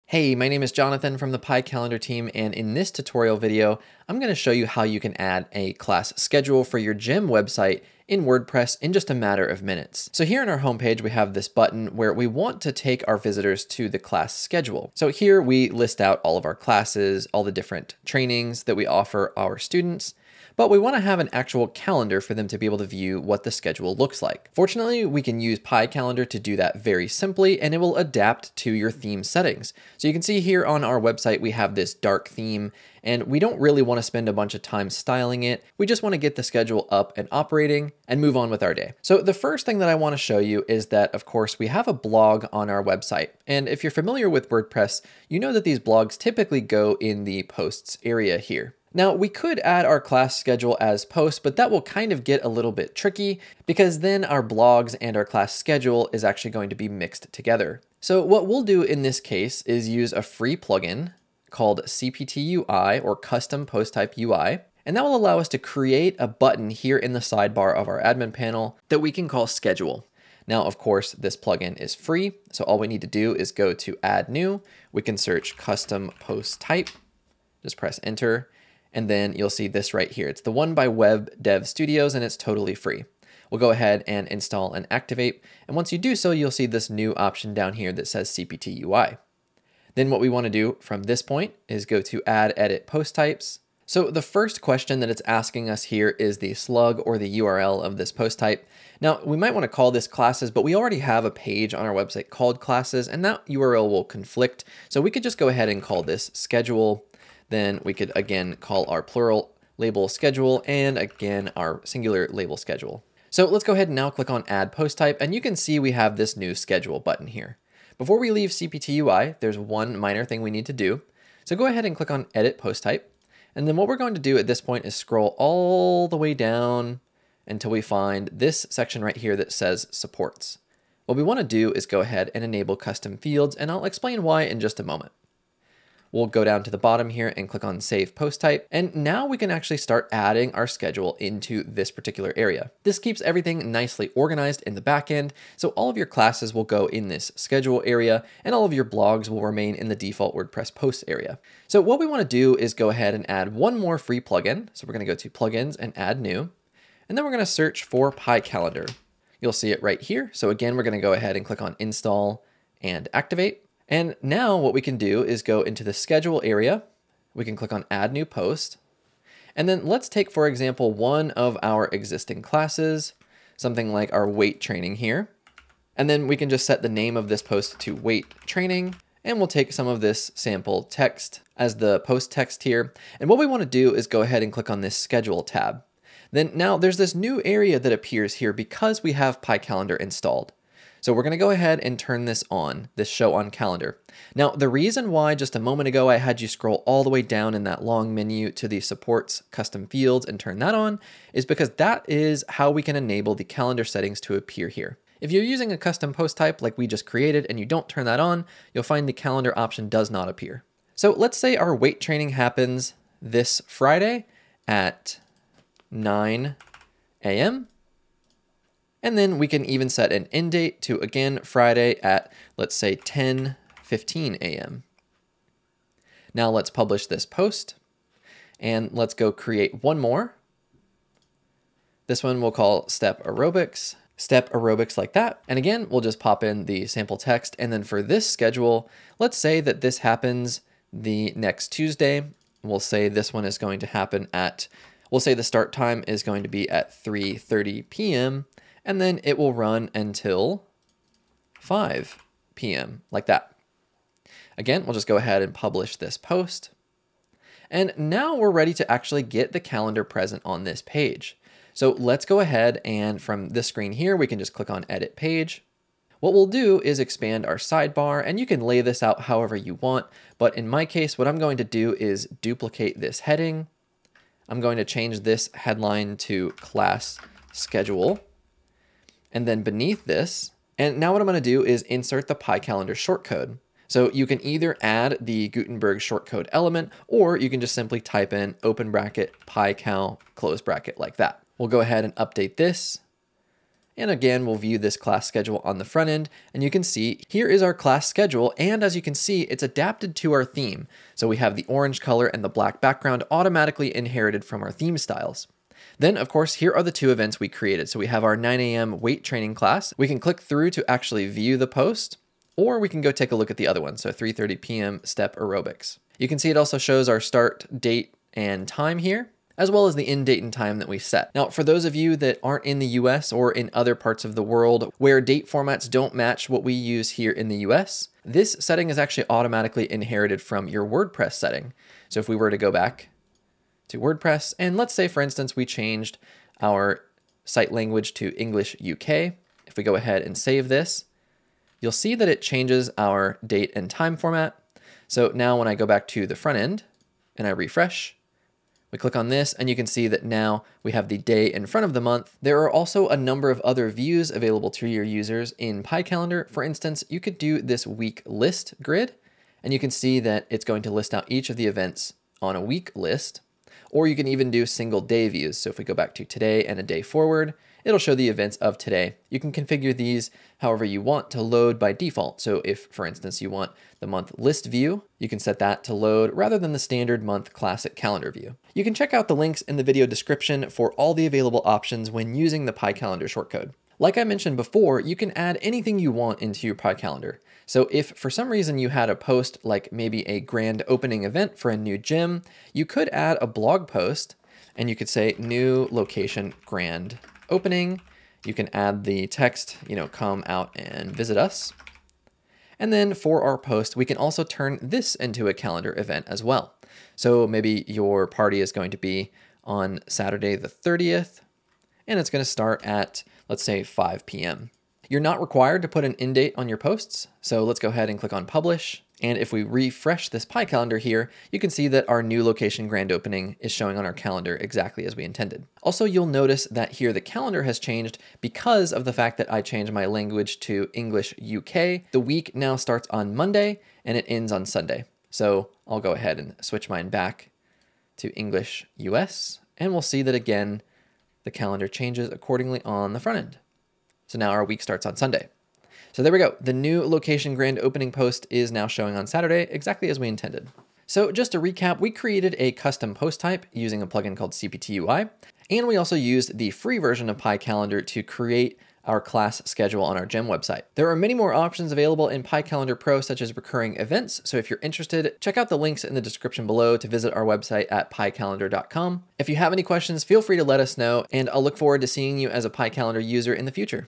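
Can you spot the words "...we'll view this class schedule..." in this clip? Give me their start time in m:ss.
4:54.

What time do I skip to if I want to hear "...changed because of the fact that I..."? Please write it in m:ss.
7:07.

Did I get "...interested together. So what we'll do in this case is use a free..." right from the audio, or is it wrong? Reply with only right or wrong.
wrong.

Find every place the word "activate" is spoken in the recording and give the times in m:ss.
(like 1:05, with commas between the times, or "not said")
1:24, 2:43.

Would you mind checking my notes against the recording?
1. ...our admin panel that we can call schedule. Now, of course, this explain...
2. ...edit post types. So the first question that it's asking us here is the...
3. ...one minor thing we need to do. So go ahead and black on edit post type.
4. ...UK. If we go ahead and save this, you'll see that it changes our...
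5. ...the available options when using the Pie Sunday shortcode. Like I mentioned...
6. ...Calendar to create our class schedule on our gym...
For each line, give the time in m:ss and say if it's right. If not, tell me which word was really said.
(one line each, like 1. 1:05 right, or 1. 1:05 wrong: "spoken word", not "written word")
1. 1:07 wrong: "plugin", not "explain"
2. 1:32 right
3. 1:59 wrong: "click", not "black"
4. 5:38 right
5. 6:21 wrong: "Calendar", not "Sunday"
6. 7:37 right.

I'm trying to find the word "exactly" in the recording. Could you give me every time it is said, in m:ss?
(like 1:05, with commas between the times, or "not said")
7:04, 7:29.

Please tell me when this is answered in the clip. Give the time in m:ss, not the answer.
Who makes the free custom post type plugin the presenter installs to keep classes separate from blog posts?
1:20.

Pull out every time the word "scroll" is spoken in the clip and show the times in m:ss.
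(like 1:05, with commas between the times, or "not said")
2:04, 3:16.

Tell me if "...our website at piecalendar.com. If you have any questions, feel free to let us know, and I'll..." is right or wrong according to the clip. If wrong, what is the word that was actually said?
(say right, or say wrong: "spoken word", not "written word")
right.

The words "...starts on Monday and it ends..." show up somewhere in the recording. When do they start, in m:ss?
7:12.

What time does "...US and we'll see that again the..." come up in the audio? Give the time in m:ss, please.
7:18.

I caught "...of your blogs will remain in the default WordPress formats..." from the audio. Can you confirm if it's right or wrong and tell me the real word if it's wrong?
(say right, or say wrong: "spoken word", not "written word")
wrong: "posts", not "formats".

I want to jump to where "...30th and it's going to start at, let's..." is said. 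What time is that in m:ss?
6:50.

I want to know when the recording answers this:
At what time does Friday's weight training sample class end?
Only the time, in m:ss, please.
3:42.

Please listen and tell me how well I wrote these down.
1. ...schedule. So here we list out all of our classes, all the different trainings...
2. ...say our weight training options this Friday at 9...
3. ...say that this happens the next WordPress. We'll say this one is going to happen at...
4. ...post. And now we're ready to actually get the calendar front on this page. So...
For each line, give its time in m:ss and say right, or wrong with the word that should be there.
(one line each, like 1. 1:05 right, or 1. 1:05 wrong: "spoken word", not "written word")
1. 0:14 right
2. 3:31 wrong: "happens", not "options"
3. 3:59 wrong: "Tuesday", not "WordPress"
4. 4:16 wrong: "present", not "front".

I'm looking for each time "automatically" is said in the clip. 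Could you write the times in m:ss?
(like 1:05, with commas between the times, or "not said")
5:03, 5:29.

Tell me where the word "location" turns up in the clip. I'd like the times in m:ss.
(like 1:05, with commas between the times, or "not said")
6:35, 7:02, 7:27.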